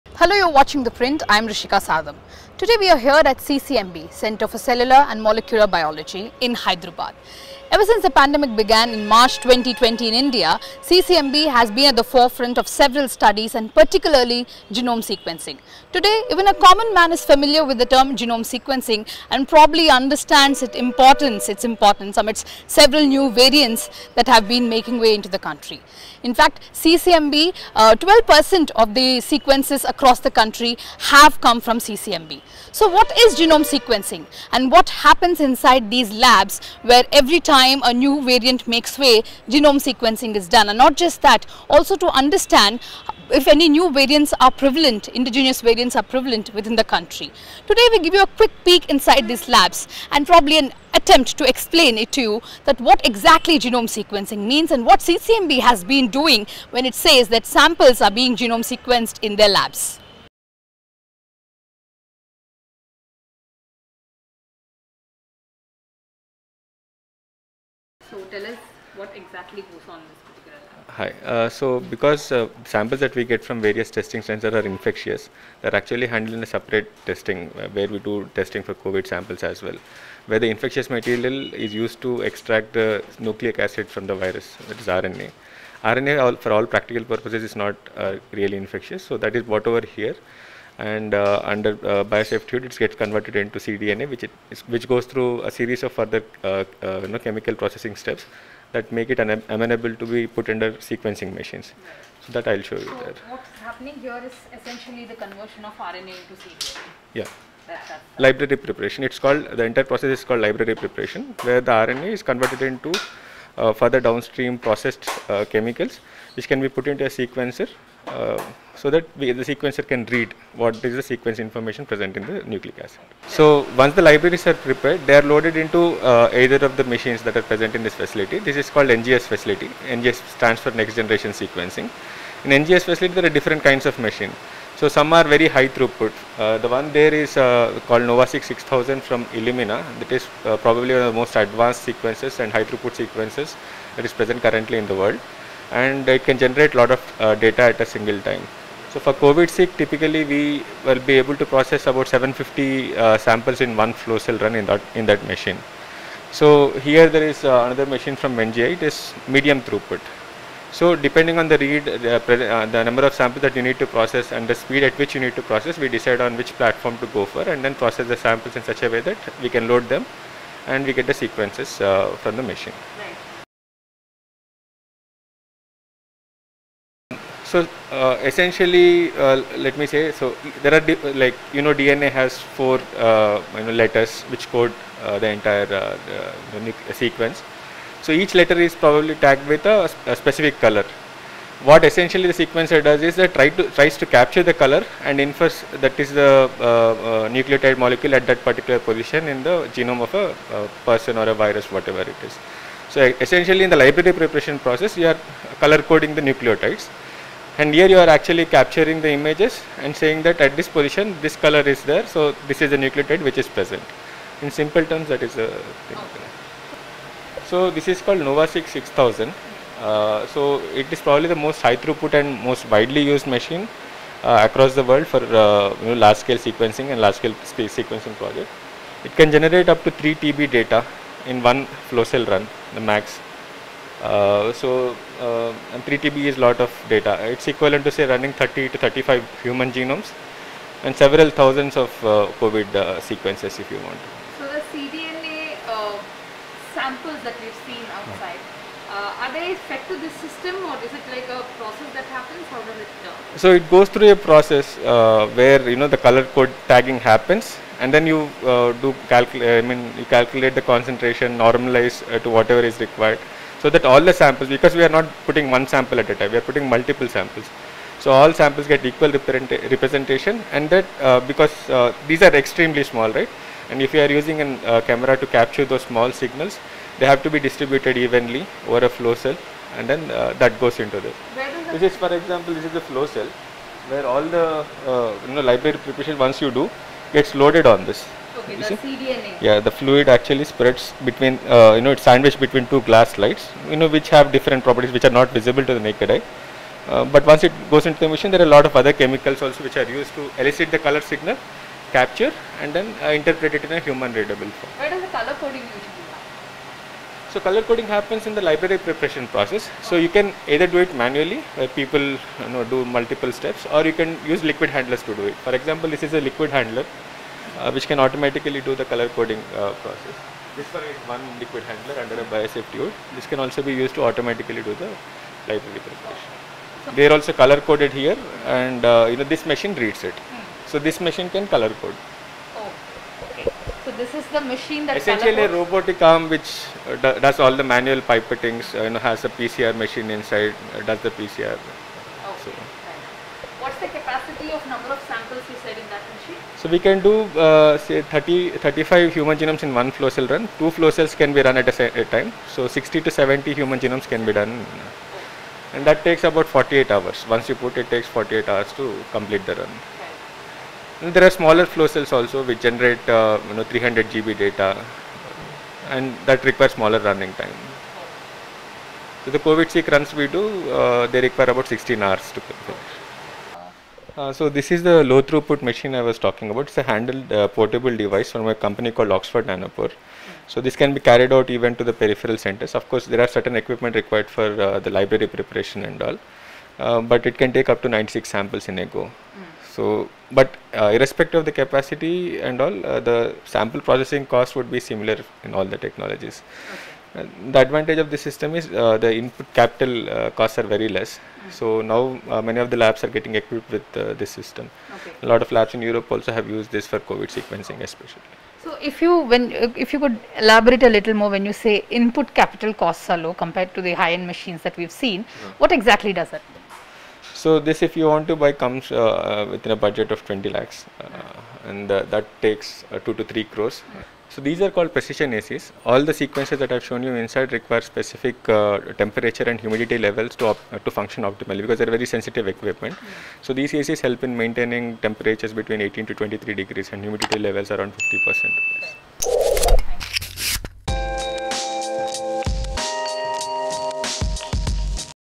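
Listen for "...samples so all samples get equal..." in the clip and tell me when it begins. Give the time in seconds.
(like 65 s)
267 s.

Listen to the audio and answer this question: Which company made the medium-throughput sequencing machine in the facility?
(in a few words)
MGI.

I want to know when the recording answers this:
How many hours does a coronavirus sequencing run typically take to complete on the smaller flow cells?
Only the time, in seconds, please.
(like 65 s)
371 s.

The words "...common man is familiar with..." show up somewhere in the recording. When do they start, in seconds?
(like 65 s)
16 s.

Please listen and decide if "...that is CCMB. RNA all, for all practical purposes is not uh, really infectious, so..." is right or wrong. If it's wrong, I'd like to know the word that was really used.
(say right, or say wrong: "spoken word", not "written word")
wrong: "RNA", not "CCMB".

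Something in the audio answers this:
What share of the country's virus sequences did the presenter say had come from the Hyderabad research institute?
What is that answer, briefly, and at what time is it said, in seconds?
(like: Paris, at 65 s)
12%, at 27 s.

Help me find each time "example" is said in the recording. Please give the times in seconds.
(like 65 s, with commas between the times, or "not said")
282 s, 315 s.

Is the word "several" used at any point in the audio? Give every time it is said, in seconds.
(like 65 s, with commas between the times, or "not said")
12 s, 22 s, 240 s.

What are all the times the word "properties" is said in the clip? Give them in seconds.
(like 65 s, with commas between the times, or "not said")
294 s.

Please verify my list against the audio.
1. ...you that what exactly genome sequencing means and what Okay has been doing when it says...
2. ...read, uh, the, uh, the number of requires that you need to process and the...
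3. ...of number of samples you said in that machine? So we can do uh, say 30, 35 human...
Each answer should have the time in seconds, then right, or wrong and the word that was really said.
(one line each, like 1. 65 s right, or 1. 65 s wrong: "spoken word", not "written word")
1. 52 s wrong: "CCMB", not "Okay"
2. 161 s wrong: "samples", not "requires"
3. 344 s right.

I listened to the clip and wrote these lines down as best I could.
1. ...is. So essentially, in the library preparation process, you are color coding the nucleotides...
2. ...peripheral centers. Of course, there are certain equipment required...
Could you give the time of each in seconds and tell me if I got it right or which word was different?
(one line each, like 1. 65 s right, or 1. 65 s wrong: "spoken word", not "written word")
1. 202 s right
2. 381 s right.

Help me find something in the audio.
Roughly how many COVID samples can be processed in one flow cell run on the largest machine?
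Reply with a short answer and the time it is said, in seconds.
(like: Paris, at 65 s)
750, at 152 s.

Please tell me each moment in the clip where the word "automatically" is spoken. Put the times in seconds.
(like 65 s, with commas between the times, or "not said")
317 s, 324 s.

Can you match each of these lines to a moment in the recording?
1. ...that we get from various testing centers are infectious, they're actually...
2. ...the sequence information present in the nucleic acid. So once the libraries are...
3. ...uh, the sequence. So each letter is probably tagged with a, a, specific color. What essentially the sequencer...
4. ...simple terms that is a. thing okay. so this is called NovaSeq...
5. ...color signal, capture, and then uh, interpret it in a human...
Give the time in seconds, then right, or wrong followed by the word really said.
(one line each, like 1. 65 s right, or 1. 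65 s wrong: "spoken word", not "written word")
1. 72 s right
2. 120 s right
3. 185 s right
4. 214 s right
5. 300 s right.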